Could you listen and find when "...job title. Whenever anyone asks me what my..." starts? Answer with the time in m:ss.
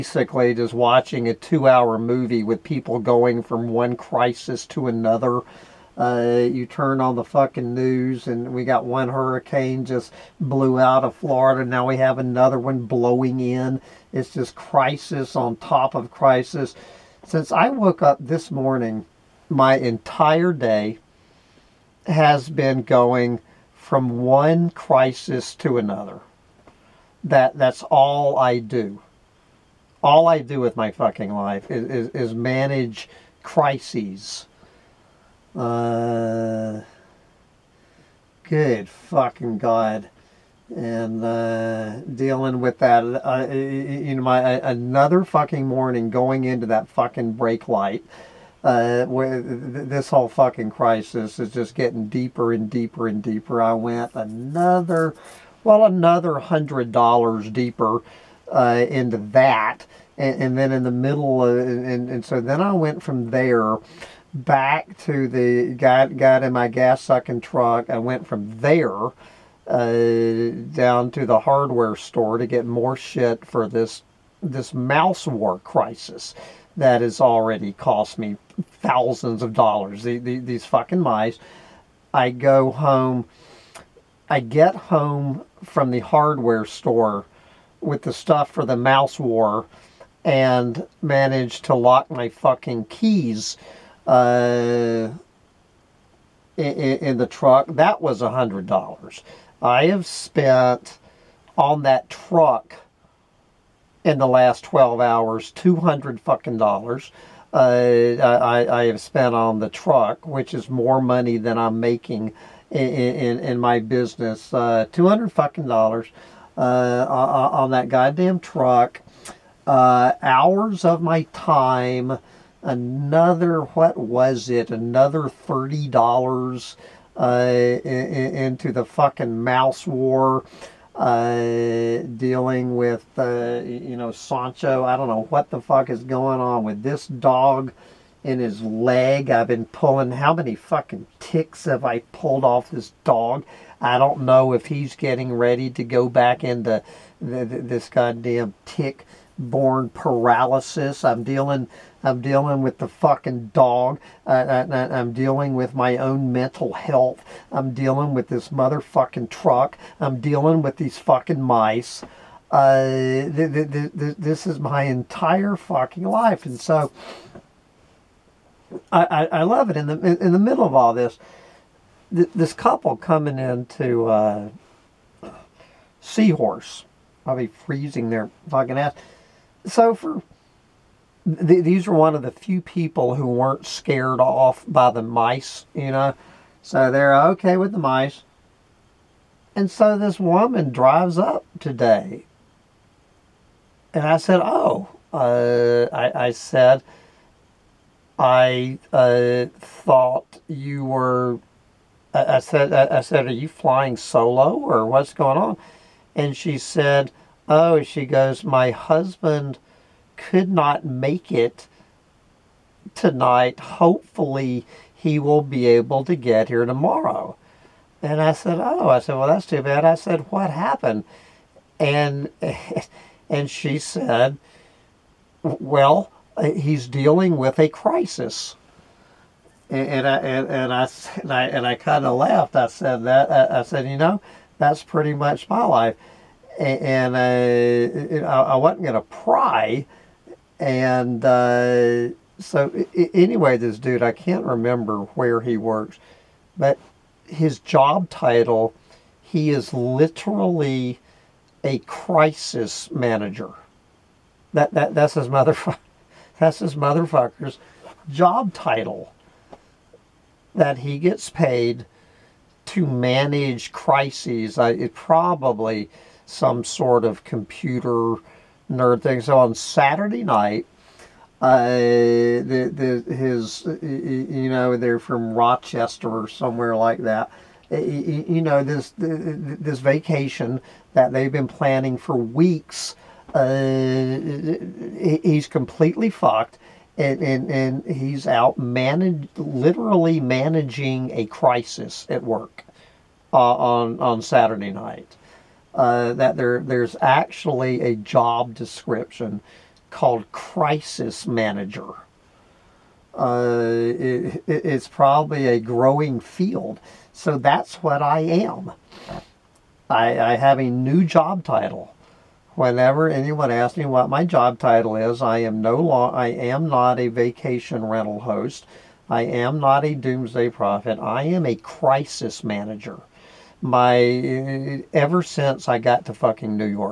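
5:11.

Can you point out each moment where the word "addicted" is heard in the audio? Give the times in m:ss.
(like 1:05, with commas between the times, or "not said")
not said.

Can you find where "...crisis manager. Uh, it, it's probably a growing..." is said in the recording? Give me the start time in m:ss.
5:00.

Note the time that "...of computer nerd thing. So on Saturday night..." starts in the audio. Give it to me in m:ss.
4:27.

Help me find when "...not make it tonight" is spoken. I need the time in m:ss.
3:30.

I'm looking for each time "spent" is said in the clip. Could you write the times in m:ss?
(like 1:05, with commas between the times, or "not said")
1:40, 1:48.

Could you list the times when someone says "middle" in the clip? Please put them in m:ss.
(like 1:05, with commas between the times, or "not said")
1:00, 2:50.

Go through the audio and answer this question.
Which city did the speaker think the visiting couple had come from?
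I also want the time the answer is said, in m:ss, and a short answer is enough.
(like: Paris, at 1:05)
Rochester, at 4:35.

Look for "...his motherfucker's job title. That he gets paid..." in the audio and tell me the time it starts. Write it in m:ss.
4:16.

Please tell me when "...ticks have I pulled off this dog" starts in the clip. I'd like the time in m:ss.
2:21.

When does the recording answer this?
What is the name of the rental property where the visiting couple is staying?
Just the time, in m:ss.
2:55.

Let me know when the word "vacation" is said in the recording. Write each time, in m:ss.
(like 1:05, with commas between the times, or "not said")
4:39, 5:17.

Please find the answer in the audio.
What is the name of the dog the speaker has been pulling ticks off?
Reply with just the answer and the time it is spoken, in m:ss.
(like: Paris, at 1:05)
Sancho, at 2:14.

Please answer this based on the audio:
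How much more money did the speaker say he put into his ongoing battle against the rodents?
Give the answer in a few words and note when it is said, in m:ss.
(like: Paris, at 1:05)
$30, at 2:05.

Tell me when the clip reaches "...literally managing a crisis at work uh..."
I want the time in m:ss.
4:49.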